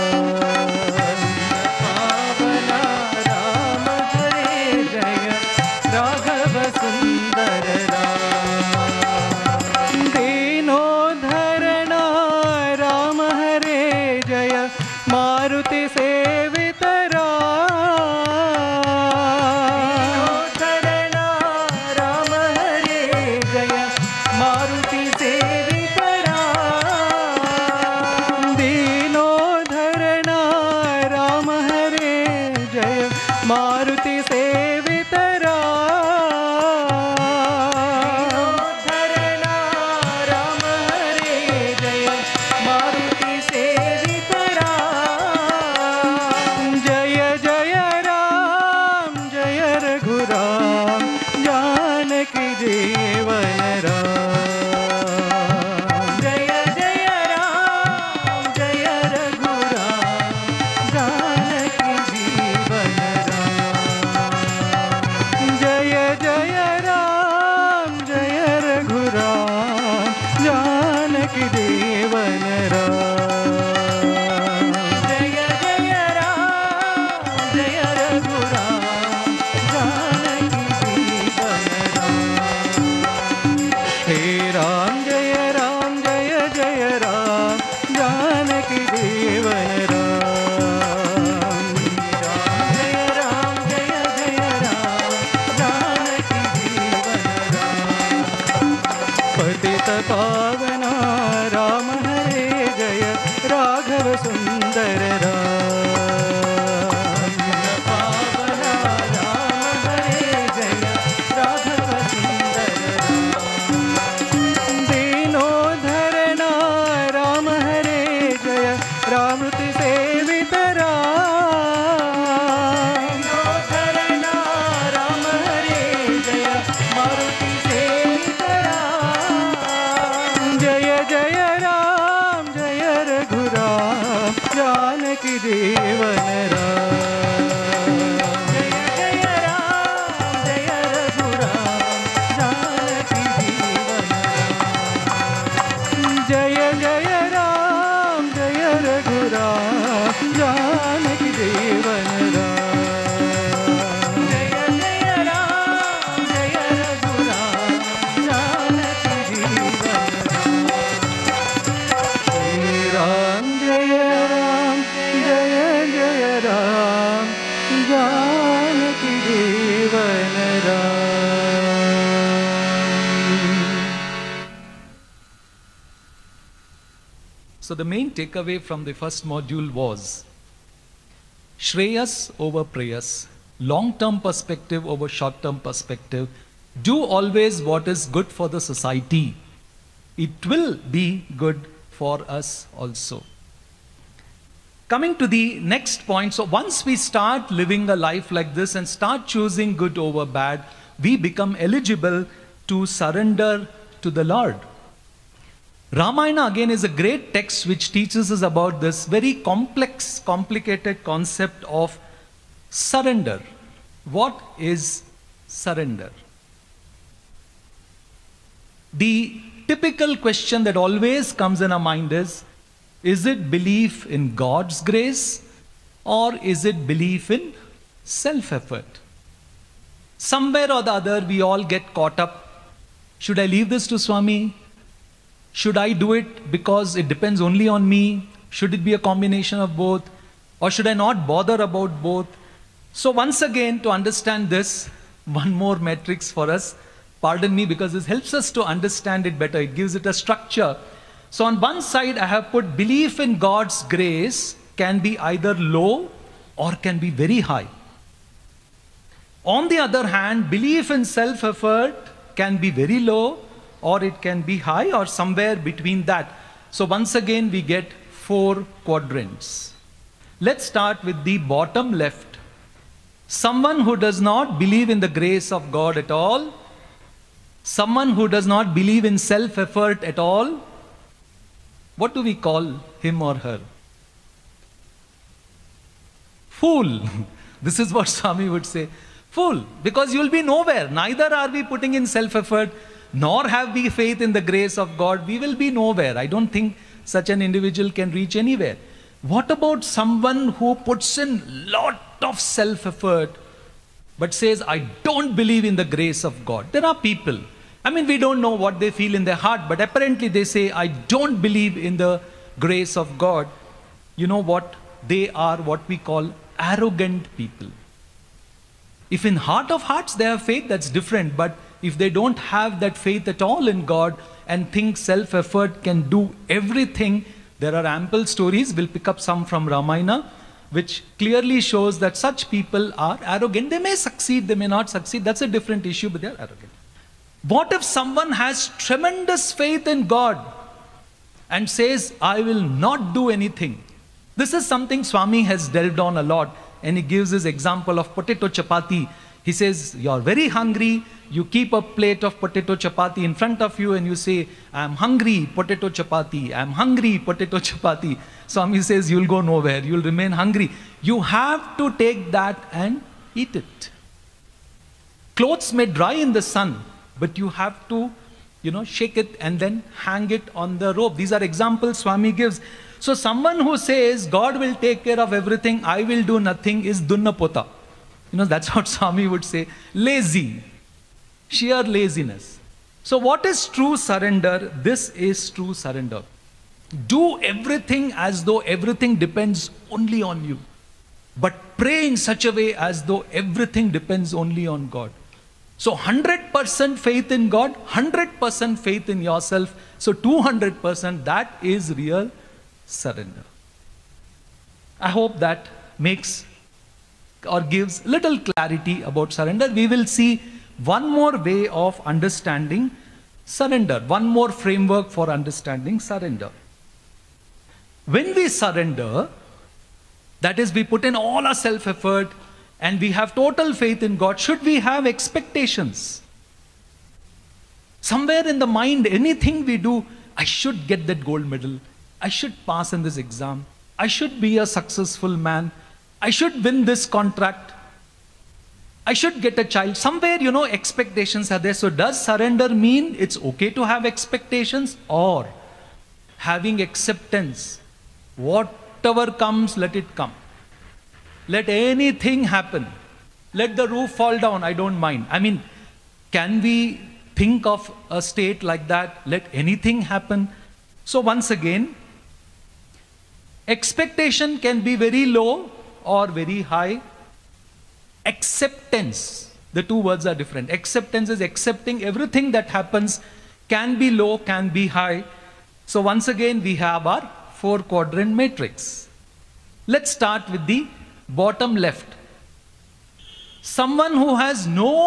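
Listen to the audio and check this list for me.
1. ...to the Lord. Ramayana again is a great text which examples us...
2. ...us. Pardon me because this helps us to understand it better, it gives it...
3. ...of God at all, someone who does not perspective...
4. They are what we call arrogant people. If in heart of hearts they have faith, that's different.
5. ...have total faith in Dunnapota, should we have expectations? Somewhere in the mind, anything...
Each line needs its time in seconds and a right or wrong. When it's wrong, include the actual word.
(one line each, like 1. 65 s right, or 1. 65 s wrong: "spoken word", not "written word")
1. 204 s wrong: "teaches", not "examples"
2. 246 s right
3. 275 s wrong: "believe", not "perspective"
4. 315 s right
5. 423 s wrong: "God", not "Dunnapota".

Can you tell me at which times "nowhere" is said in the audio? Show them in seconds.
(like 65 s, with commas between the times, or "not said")
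290 s, 295 s, 359 s.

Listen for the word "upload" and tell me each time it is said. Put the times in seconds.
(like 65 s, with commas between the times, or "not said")
not said.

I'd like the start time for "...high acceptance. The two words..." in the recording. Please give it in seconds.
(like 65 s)
466 s.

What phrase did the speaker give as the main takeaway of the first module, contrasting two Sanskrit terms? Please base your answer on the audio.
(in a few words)
Shreyas over preyas.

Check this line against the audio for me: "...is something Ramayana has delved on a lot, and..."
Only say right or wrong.
wrong.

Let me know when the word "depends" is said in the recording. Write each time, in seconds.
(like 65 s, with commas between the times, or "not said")
237 s, 389 s, 393 s.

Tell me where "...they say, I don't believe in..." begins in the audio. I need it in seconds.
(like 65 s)
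310 s.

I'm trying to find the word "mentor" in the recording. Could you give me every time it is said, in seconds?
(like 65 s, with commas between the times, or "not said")
not said.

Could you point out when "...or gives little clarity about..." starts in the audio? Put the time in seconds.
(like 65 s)
407 s.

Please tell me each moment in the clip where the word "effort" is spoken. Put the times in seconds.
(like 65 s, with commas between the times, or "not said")
228 s, 261 s, 279 s, 292 s, 302 s, 325 s, 421 s.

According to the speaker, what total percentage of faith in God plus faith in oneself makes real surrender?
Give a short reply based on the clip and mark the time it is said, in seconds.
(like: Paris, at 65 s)
200%, at 400 s.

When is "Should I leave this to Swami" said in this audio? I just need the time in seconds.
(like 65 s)
233 s.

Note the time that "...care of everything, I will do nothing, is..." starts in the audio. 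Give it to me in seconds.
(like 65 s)
375 s.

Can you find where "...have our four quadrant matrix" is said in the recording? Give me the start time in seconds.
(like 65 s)
476 s.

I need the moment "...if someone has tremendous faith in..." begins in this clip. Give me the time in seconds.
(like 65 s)
337 s.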